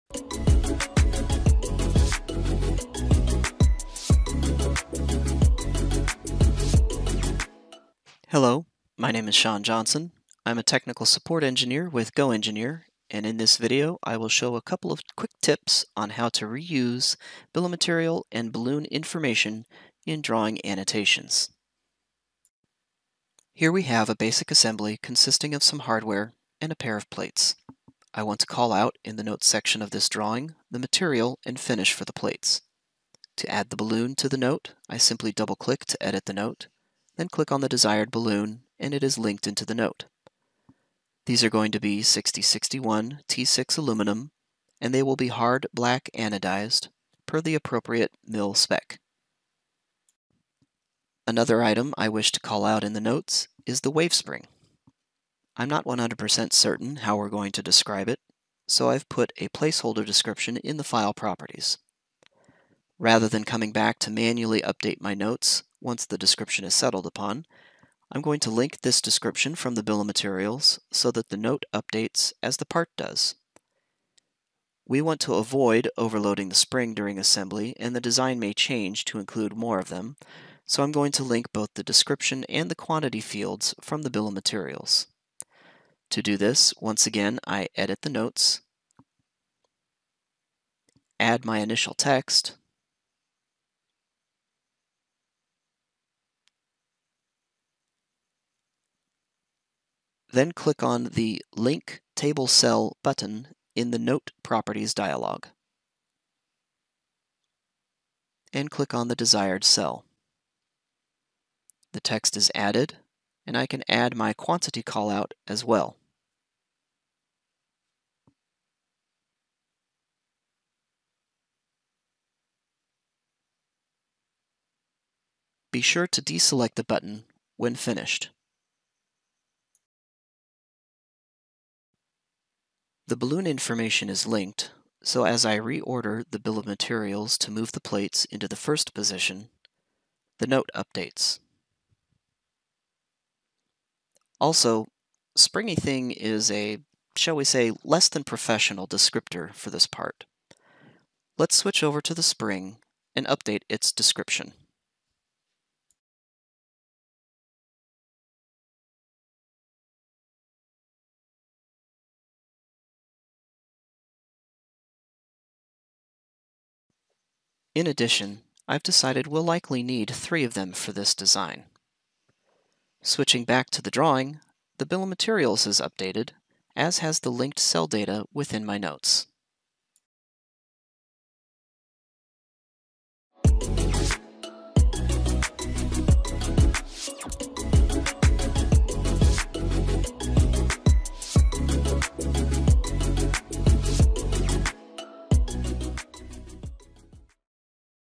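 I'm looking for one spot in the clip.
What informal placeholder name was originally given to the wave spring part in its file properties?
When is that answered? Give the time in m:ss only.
2:25.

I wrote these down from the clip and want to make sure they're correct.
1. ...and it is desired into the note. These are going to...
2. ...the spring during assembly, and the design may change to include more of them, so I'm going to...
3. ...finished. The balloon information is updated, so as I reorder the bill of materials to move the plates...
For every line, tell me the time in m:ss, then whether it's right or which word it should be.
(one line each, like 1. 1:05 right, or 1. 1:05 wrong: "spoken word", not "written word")
1. 0:38 wrong: "linked", not "desired"
2. 1:16 right
3. 2:07 wrong: "linked", not "updated".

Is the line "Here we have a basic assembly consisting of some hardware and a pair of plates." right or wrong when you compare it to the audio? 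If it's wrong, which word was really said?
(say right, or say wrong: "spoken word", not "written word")
right.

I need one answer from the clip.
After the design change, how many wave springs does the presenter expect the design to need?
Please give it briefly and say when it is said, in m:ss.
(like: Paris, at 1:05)
3, at 2:50.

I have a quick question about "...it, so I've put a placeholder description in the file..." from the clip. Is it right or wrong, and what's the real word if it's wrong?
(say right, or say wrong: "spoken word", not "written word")
right.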